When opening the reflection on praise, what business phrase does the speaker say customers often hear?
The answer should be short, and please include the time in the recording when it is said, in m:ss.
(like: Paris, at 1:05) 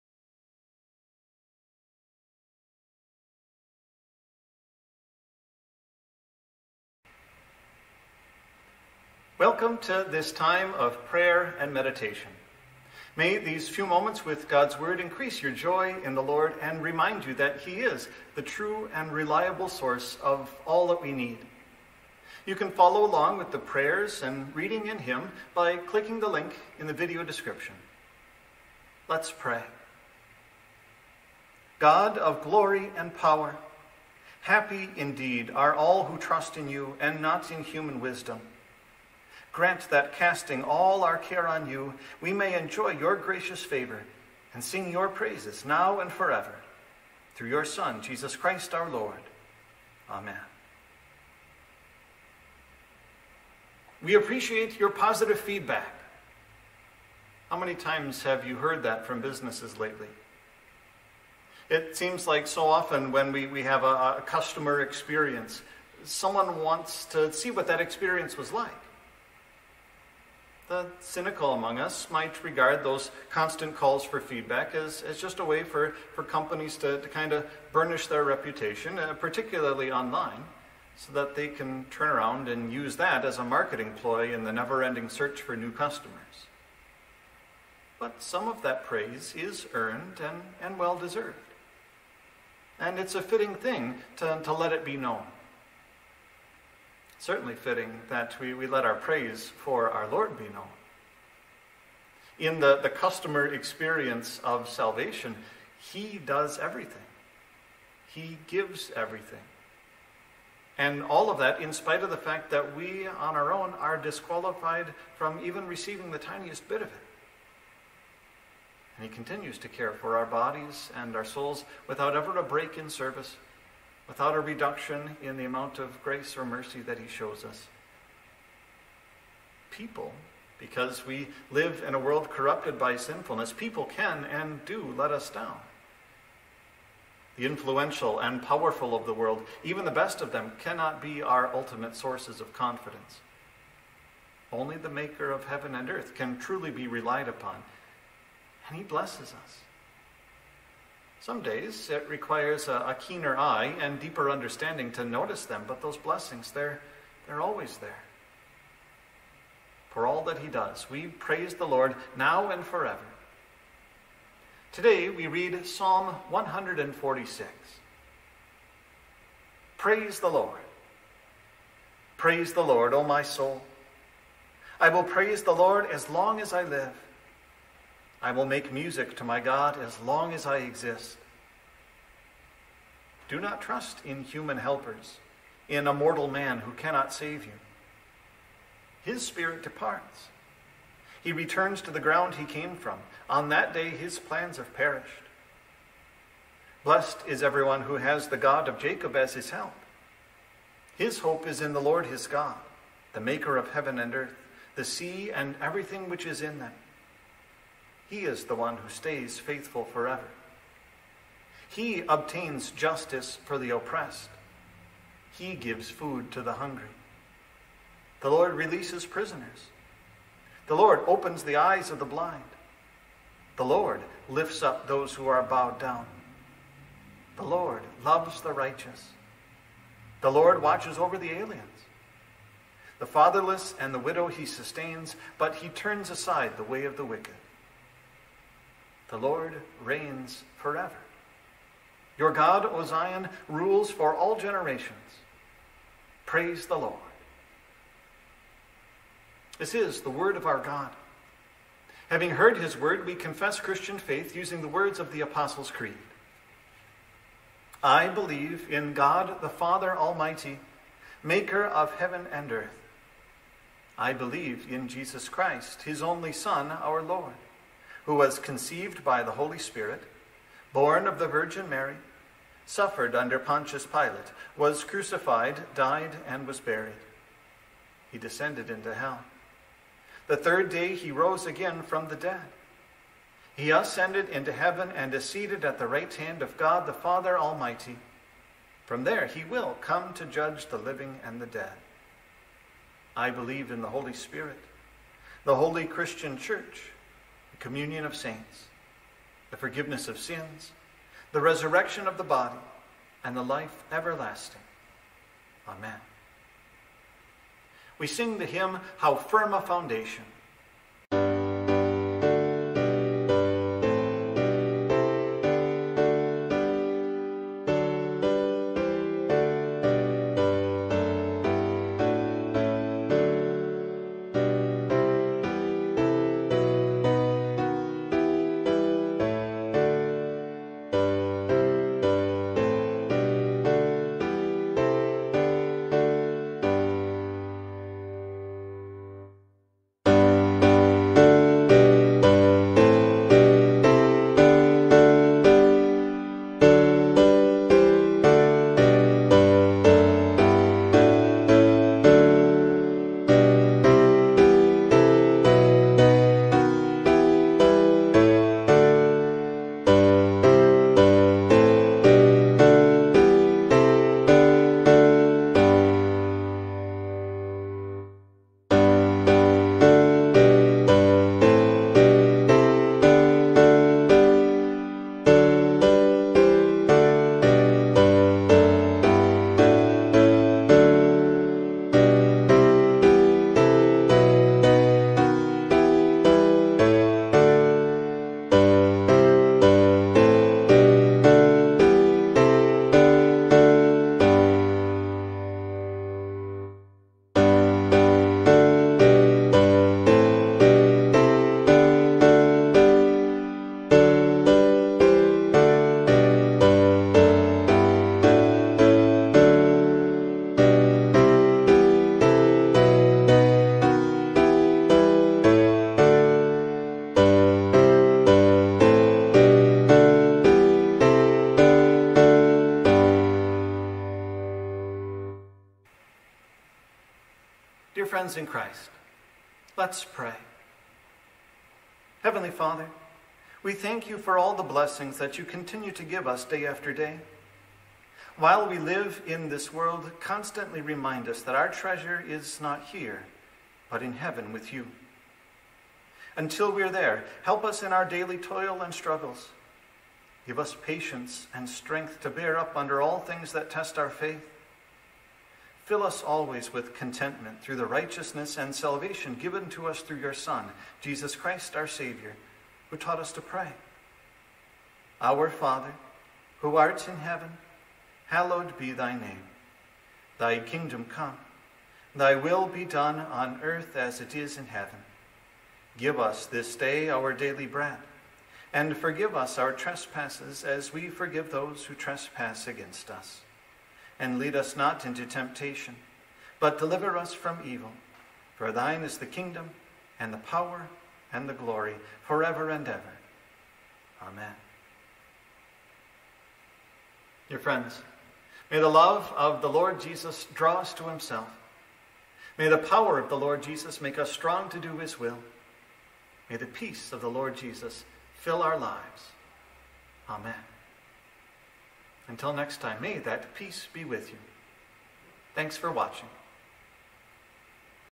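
We appreciate your positive feedback, at 0:54.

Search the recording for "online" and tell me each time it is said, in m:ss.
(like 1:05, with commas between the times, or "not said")
1:19.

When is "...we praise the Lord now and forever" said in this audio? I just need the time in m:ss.
2:40.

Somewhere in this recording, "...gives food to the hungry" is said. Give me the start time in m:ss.
3:35.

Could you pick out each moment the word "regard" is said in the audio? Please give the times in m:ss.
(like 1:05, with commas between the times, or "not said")
1:12.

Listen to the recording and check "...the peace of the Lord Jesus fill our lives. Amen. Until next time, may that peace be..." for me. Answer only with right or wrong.
right.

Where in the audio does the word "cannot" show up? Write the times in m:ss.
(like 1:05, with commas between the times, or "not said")
2:20, 3:06.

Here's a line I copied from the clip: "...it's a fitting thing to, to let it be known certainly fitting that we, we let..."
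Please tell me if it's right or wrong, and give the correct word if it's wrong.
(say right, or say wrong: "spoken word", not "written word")
right.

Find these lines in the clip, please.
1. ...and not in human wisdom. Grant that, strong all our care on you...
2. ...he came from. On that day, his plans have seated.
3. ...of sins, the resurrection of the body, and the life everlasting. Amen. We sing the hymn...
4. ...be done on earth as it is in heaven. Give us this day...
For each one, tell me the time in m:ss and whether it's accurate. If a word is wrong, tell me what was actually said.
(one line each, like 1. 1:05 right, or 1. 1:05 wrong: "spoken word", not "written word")
1. 0:36 wrong: "casting", not "strong"
2. 3:12 wrong: "perished", not "seated"
3. 5:00 right
4. 7:52 right.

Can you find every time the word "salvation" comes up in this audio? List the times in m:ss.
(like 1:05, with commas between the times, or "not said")
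1:44, 7:38.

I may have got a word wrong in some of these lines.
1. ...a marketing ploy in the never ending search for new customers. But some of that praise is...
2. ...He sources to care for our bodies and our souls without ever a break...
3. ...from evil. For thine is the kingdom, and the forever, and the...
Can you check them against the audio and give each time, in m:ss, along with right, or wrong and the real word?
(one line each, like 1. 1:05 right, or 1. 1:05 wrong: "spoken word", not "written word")
1. 1:23 right
2. 1:59 wrong: "continues", not "sources"
3. 8:07 wrong: "power", not "forever".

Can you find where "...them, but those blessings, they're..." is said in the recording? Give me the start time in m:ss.
2:35.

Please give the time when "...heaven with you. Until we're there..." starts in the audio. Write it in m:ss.
7:24.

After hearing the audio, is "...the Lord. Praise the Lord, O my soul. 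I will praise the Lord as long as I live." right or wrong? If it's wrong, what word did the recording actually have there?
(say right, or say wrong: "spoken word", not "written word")
right.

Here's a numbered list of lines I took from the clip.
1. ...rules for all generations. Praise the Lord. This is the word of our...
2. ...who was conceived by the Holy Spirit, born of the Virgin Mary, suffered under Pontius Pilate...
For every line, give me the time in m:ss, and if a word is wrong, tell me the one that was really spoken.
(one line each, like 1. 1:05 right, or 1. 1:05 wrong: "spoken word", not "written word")
1. 4:03 right
2. 4:28 right.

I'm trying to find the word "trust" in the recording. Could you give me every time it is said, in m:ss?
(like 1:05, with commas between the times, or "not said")
0:36, 3:03.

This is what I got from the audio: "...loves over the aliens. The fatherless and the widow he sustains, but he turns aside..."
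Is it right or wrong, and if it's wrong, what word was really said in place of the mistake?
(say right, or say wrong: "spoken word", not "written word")
wrong: "watches", not "loves".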